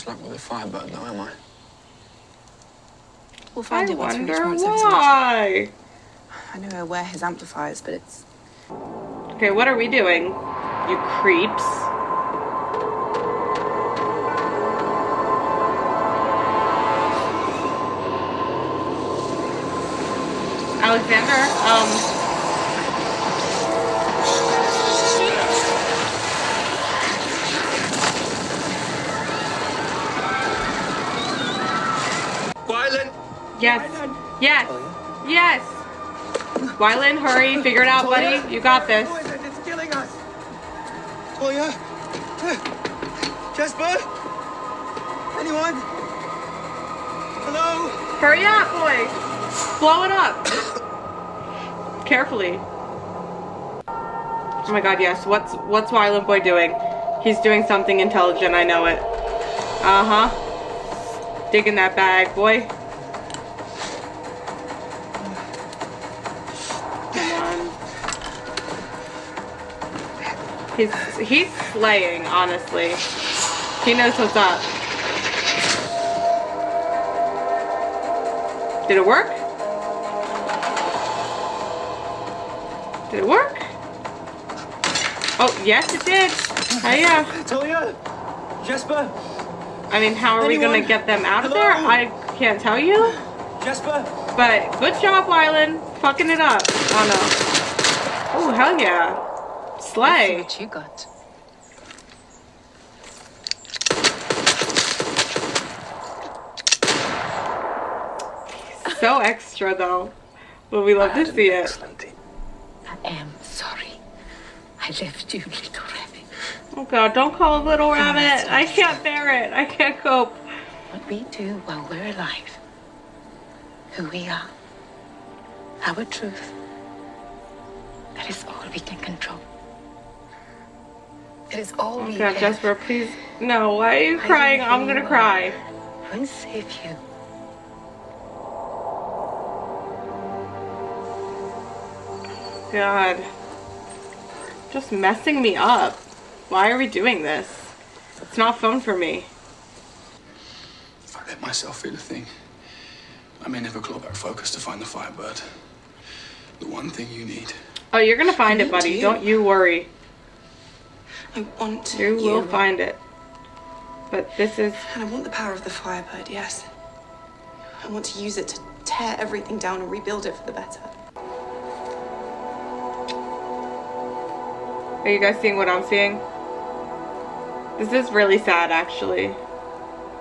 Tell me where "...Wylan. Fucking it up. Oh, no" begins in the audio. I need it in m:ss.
1:35.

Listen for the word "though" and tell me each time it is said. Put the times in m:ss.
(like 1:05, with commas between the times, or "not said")
0:00, 1:49.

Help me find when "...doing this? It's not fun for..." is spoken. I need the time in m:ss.
2:26.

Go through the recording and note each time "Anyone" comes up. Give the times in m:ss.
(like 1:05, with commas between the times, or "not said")
0:45, 1:30.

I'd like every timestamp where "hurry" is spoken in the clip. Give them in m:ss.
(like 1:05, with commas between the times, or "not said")
0:37, 0:48.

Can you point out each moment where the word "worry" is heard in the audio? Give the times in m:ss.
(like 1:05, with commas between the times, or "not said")
2:39.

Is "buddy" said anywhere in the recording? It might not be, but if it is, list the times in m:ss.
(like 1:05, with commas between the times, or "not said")
0:38, 2:38.